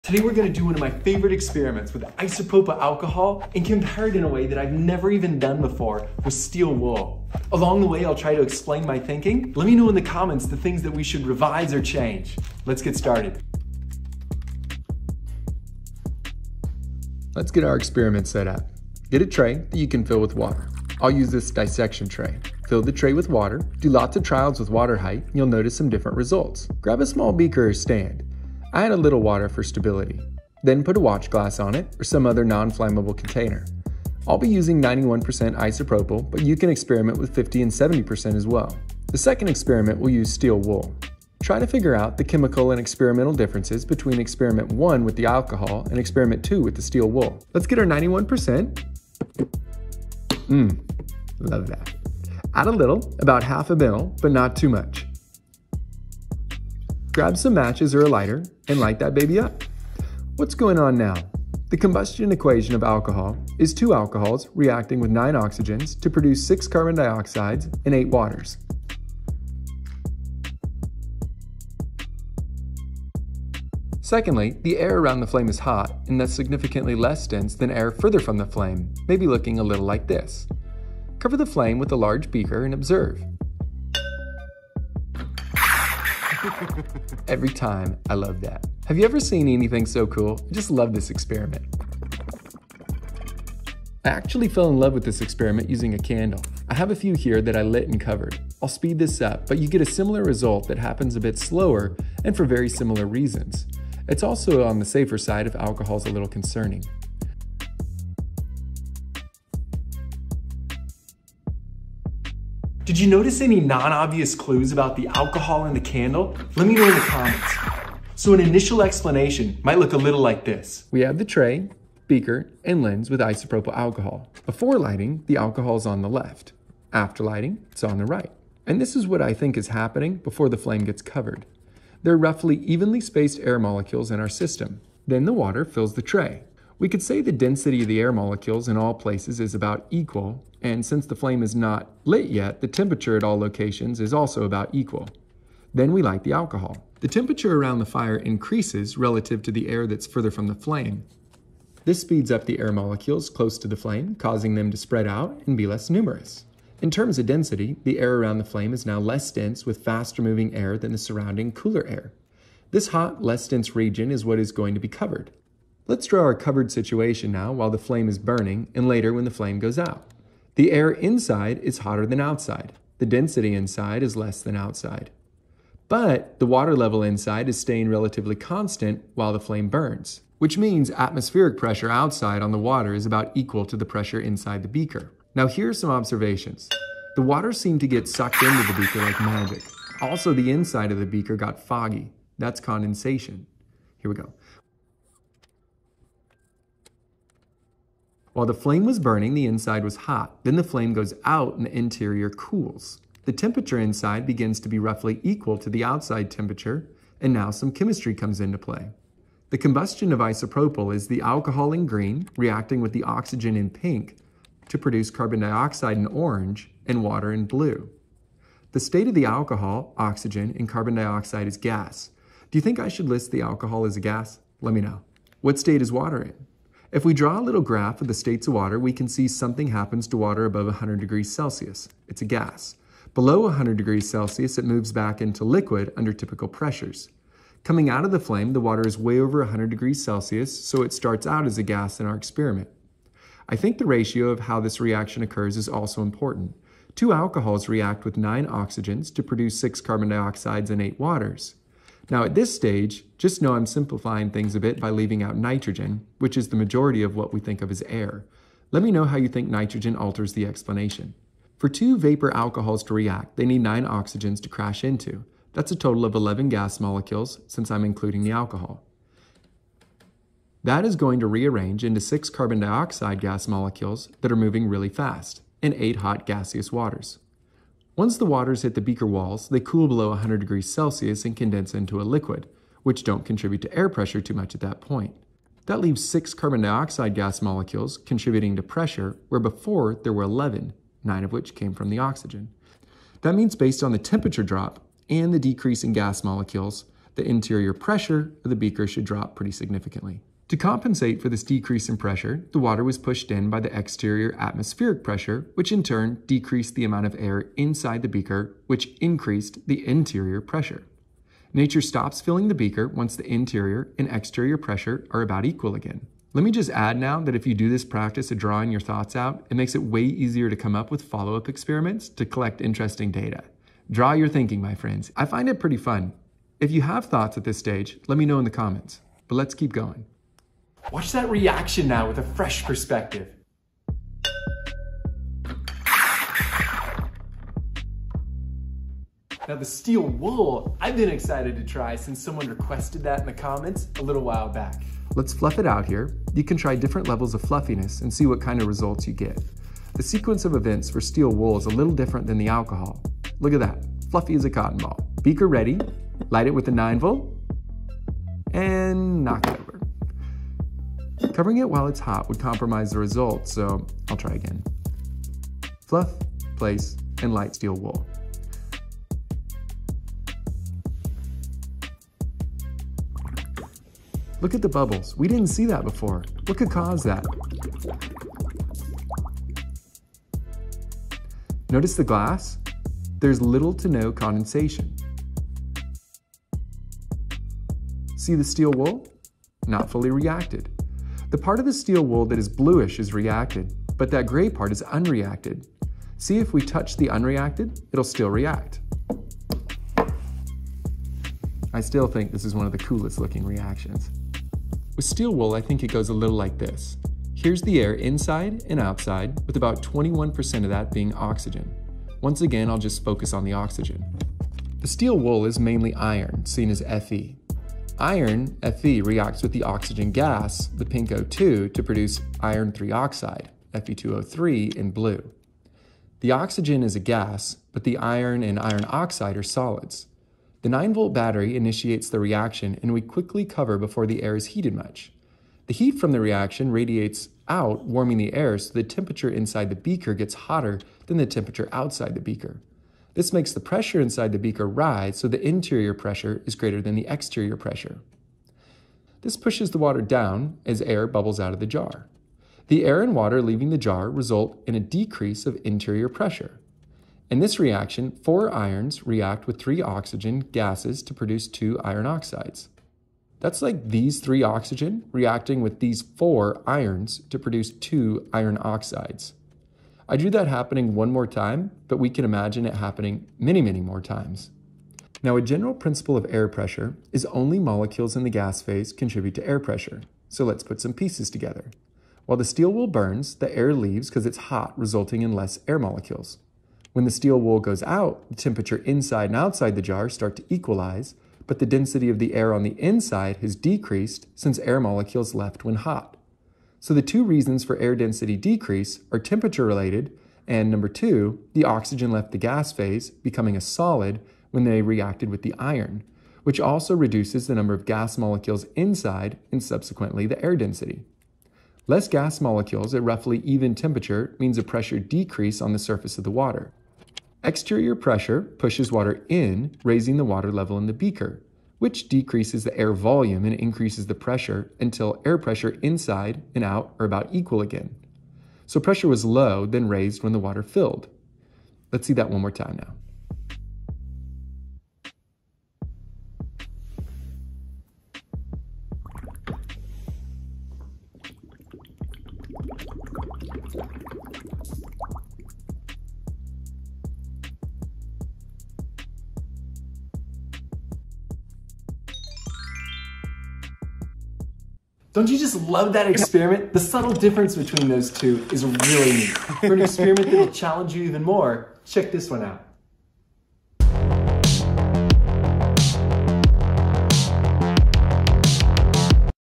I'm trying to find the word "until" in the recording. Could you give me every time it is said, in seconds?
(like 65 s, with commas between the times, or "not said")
524 s.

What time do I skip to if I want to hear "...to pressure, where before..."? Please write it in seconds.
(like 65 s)
288 s.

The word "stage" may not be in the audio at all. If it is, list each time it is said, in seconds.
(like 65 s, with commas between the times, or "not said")
252 s, 327 s.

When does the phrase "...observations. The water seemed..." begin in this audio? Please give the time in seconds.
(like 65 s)
185 s.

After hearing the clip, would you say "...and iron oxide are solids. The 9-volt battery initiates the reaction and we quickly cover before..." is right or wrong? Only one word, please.
right.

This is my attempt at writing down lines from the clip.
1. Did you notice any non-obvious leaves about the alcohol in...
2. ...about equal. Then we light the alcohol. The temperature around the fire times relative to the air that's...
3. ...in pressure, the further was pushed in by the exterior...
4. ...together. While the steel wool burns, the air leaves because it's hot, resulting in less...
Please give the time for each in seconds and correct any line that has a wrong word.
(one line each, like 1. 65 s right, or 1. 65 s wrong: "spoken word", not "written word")
1. 112 s wrong: "clues", not "leaves"
2. 144 s wrong: "increases", not "times"
3. 301 s wrong: "water", not "further"
4. 481 s right.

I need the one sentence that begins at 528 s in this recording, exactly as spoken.
So pressure was low, then raised when the water filled.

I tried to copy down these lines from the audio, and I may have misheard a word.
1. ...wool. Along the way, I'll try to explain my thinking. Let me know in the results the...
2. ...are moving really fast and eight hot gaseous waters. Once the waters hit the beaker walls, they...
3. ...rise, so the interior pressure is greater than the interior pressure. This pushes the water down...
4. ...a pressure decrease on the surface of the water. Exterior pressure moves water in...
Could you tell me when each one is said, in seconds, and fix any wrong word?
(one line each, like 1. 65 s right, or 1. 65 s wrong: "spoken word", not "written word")
1. 6 s wrong: "comments", not "results"
2. 274 s right
3. 444 s wrong: "exterior", not "interior"
4. 514 s wrong: "pushes", not "moves".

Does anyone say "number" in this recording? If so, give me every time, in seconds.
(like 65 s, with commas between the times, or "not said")
500 s, 507 s.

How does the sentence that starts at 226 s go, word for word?
If we draw a little graph of the states of water, we can see something happens to water above 100 degrees Celsius.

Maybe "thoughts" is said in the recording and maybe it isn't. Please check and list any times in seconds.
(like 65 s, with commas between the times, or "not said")
318 s, 327 s.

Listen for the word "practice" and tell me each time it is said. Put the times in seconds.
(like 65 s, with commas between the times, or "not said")
317 s.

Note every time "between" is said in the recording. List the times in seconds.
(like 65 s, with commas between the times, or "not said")
43 s, 557 s.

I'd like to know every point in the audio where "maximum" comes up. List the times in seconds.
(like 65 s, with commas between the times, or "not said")
not said.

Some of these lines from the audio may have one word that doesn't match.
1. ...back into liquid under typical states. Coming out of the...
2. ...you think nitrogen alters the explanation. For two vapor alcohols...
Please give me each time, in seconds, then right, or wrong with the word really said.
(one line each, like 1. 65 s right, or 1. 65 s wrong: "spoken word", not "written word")
1. 234 s wrong: "pressures", not "states"
2. 259 s right.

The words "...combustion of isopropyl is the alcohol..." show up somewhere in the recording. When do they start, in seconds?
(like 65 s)
209 s.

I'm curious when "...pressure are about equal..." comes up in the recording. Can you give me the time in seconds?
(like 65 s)
314 s.